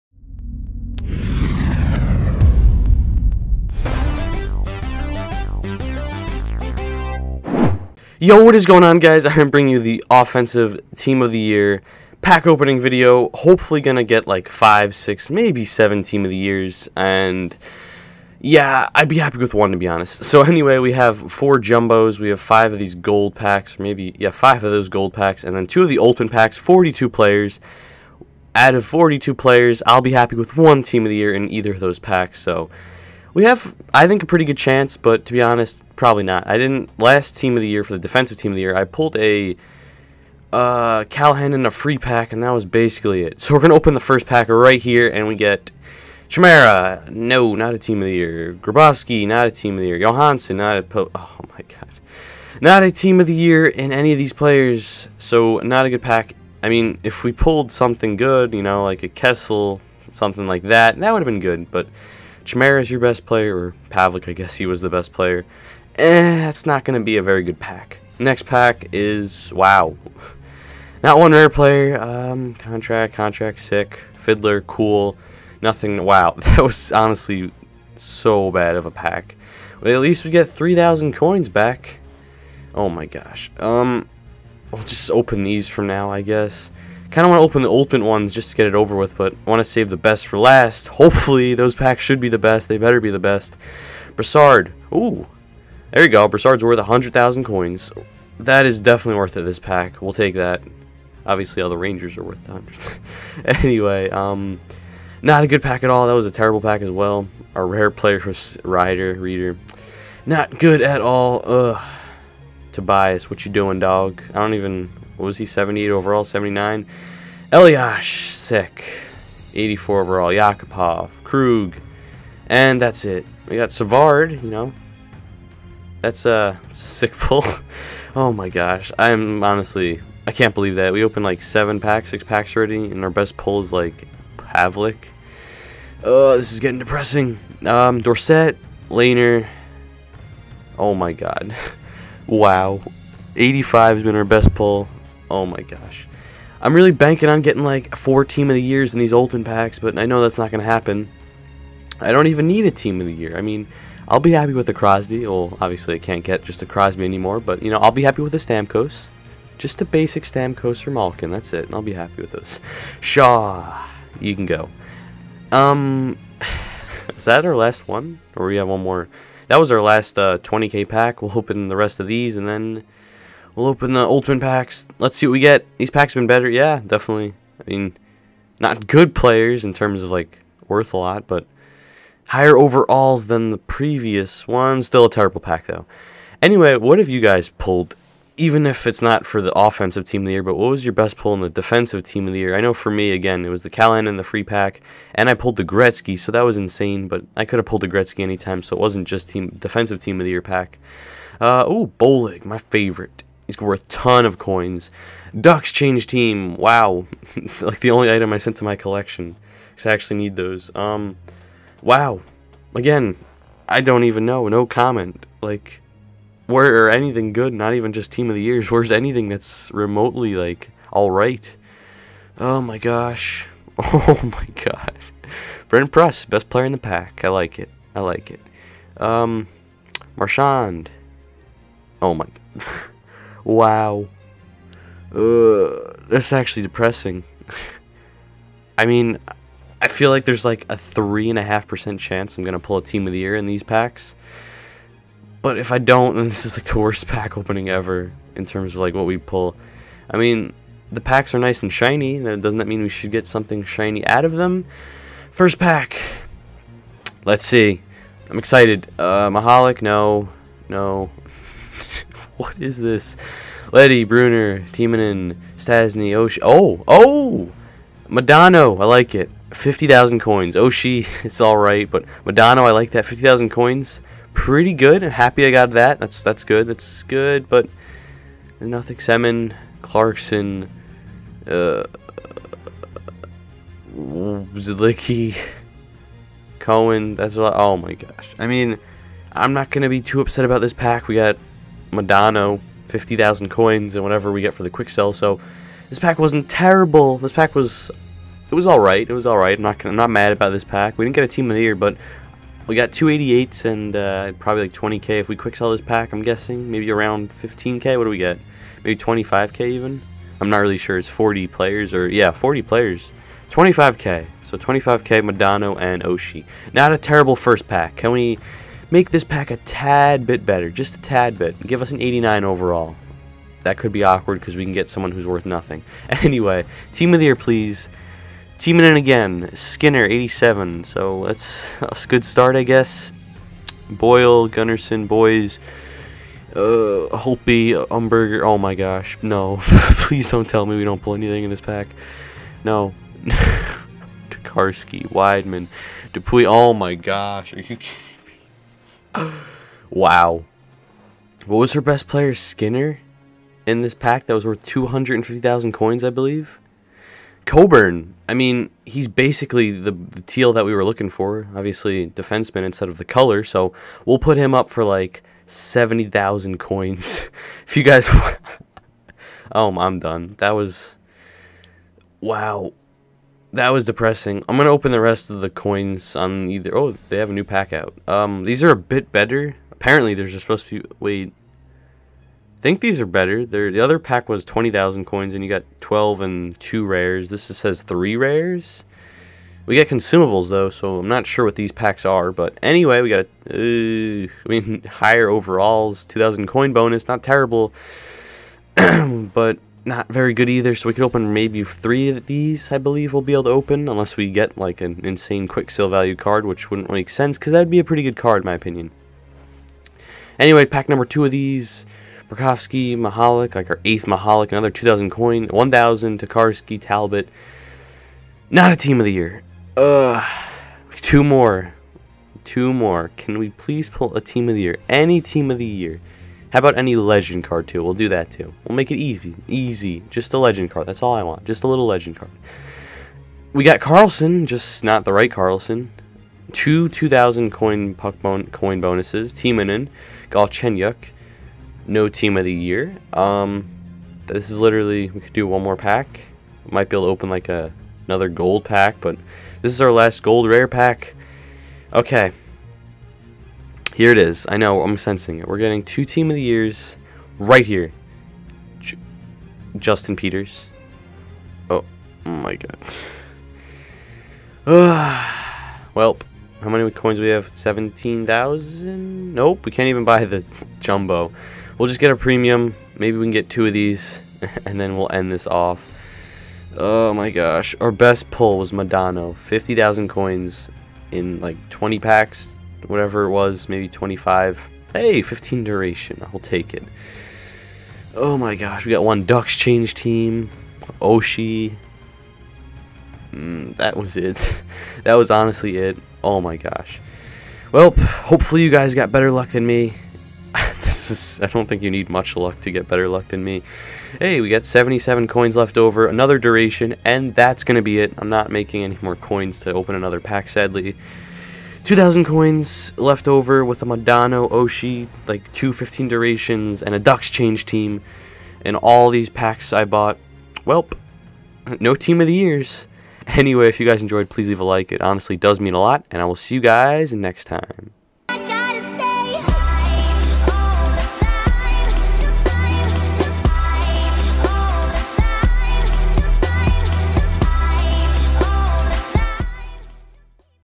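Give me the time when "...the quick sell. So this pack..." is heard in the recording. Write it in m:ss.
4:54.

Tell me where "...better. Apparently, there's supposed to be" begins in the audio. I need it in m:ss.
6:19.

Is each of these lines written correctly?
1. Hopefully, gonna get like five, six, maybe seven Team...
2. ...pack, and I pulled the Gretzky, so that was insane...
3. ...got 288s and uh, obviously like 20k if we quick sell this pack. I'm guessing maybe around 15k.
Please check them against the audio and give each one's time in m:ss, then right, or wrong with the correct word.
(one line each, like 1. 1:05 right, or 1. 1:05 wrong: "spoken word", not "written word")
1. 0:13 right
2. 3:14 right
3. 5:02 wrong: "probably", not "obviously".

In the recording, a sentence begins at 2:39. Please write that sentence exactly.
Just a basic Stamkos or Malkin, that's it.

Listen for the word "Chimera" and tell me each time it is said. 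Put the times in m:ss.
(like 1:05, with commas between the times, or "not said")
0:46, 1:02.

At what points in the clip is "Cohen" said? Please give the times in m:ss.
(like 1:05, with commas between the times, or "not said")
4:46.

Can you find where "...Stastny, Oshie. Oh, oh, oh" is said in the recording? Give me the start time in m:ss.
4:25.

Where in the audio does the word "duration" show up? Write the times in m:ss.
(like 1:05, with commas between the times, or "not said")
8:05, 8:26, 8:36.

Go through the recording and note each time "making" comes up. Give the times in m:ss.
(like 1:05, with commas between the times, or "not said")
8:28.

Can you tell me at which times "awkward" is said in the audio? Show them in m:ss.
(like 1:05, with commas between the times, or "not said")
5:24.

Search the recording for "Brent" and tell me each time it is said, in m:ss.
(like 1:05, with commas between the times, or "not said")
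3:45.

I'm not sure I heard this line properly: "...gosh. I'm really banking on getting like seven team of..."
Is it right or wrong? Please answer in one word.
wrong.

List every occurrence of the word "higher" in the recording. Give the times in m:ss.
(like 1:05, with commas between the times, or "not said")
3:02, 6:34.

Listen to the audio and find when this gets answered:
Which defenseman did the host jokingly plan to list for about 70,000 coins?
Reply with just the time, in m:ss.
5:57.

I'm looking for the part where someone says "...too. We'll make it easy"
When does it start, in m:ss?
7:08.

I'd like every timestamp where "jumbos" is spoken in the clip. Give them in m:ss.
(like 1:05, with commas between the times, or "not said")
0:21, 7:50.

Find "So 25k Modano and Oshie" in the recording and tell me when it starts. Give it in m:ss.
5:14.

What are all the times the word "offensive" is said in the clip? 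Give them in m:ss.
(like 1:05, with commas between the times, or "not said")
0:10, 3:09.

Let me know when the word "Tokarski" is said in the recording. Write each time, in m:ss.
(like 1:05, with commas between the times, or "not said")
5:44, 6:56.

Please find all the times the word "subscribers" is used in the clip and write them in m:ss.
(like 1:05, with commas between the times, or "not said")
not said.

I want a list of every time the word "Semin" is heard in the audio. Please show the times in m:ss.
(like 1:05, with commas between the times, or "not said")
4:38.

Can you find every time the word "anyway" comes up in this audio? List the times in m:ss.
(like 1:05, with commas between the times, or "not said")
0:20, 1:43, 3:06, 5:26, 6:32, 6:50, 8:43.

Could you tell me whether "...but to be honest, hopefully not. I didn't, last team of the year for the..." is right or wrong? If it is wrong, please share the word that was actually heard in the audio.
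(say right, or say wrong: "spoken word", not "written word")
wrong: "probably", not "hopefully".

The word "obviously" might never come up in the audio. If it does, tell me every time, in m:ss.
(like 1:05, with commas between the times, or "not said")
1:41, 2:35, 6:01.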